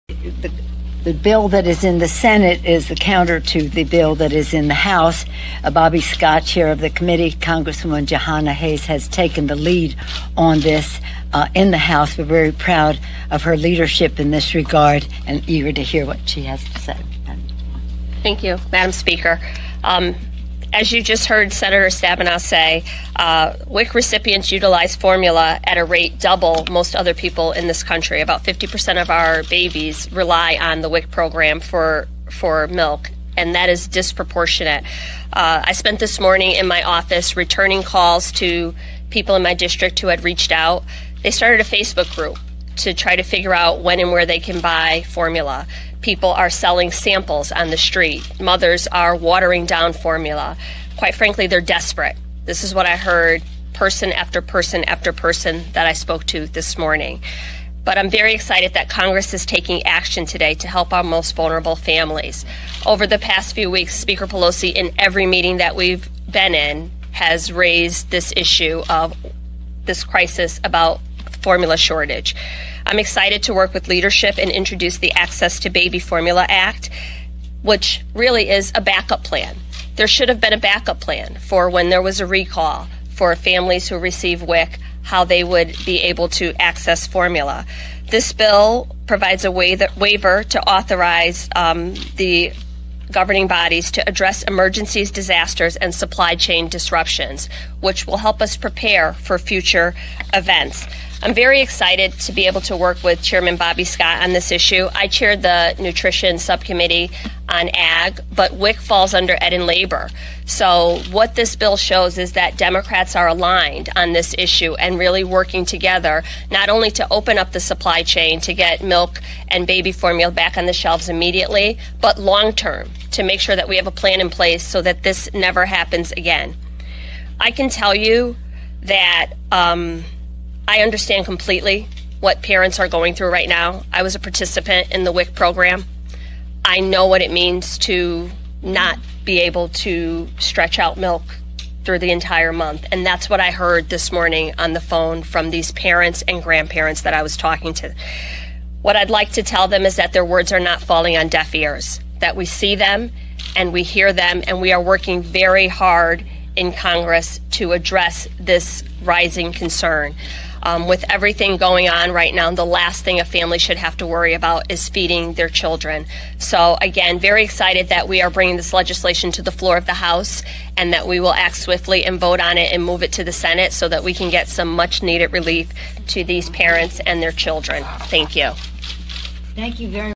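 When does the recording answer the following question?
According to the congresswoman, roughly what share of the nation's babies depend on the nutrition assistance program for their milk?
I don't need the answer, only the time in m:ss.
0:28.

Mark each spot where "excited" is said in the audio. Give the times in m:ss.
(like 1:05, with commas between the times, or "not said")
0:58, 1:12, 1:41, 2:47.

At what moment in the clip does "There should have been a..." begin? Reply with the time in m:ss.
1:19.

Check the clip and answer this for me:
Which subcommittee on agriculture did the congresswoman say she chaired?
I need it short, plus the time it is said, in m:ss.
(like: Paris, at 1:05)
Nutrition subcommittee, at 1:45.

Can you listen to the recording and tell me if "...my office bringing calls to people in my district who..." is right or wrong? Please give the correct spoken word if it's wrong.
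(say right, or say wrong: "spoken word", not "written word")
wrong: "returning", not "bringing".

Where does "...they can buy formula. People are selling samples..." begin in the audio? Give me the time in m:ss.
0:44.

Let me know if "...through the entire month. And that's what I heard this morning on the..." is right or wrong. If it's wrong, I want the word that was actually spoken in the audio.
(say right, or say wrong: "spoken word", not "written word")
right.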